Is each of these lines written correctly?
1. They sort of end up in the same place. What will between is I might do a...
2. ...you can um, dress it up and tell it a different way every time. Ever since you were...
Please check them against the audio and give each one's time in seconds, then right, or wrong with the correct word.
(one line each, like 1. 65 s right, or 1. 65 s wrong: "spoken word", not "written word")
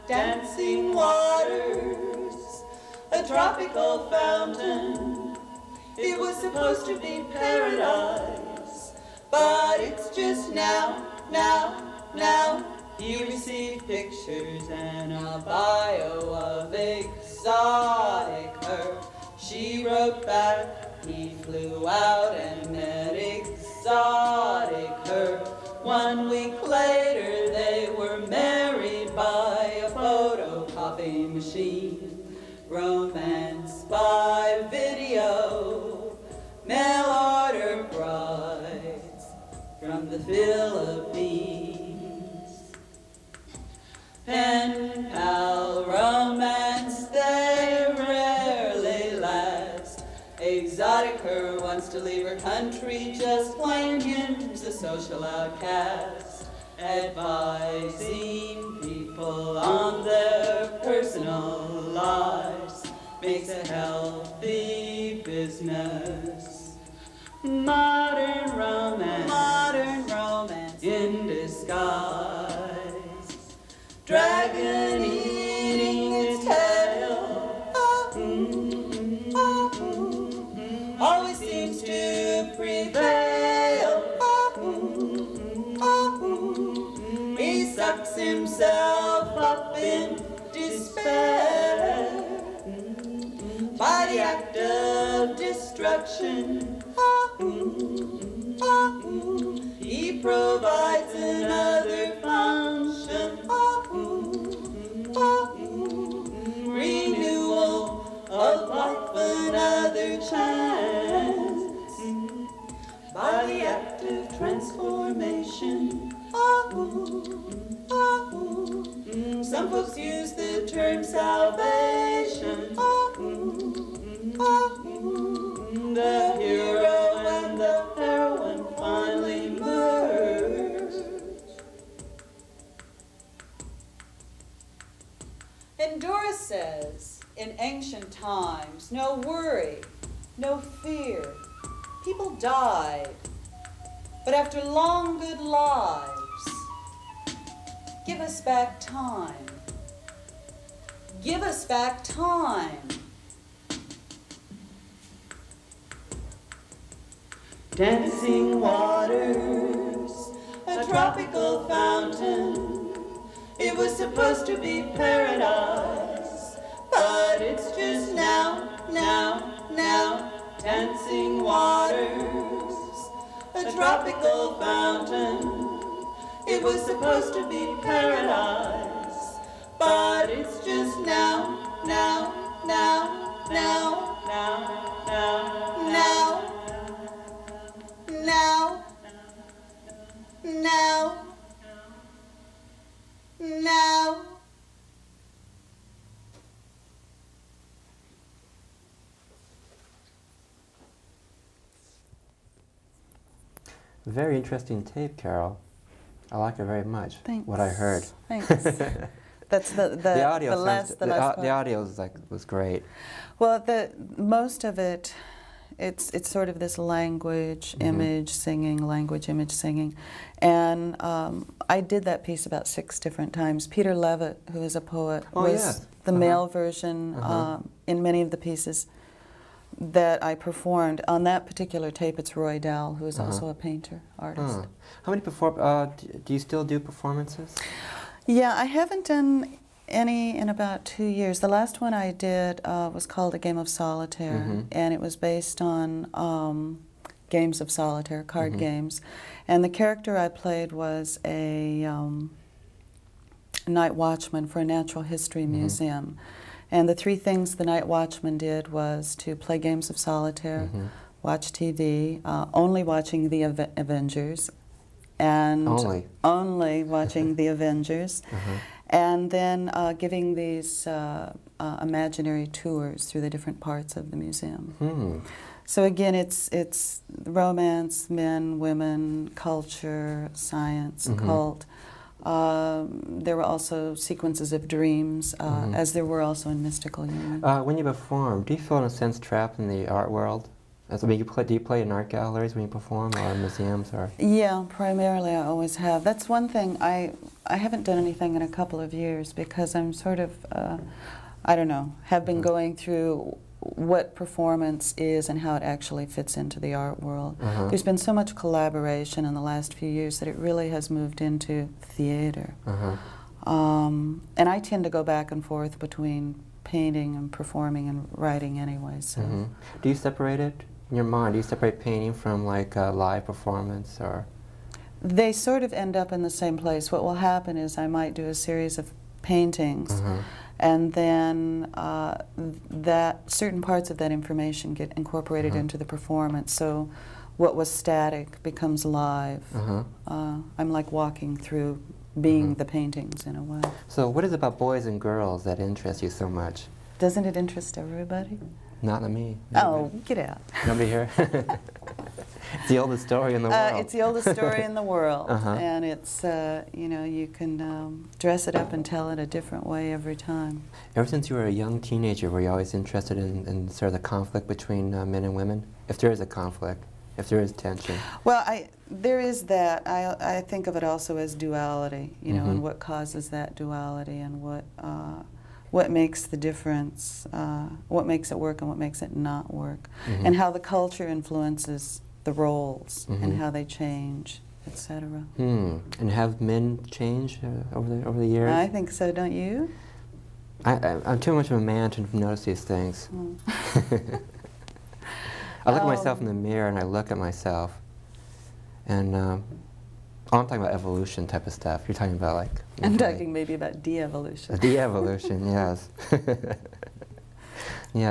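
1. 325 s wrong: "happen", not "between"
2. 357 s right.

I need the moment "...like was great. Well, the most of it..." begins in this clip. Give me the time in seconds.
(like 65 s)
211 s.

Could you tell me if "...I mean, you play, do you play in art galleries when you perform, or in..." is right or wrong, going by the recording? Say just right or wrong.
right.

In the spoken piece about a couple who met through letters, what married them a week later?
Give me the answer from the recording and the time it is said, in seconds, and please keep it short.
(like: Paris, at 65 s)
photocopy machine, at 29 s.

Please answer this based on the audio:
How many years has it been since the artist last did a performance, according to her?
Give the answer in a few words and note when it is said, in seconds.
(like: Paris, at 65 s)
2, at 240 s.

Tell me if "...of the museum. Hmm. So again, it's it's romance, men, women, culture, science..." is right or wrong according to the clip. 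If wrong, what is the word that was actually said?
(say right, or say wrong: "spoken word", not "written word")
right.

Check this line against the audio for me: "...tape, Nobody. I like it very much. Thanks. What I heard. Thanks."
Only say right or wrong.
wrong.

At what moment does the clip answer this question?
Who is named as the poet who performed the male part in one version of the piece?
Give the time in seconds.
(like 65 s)
223 s.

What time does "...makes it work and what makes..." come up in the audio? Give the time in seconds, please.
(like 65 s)
378 s.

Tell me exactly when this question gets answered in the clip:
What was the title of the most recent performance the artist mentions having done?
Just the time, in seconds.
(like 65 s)
243 s.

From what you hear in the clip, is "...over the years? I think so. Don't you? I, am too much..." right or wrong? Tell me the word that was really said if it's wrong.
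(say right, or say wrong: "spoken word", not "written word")
right.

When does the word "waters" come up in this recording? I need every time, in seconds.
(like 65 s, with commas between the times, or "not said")
0 s, 158 s, 171 s.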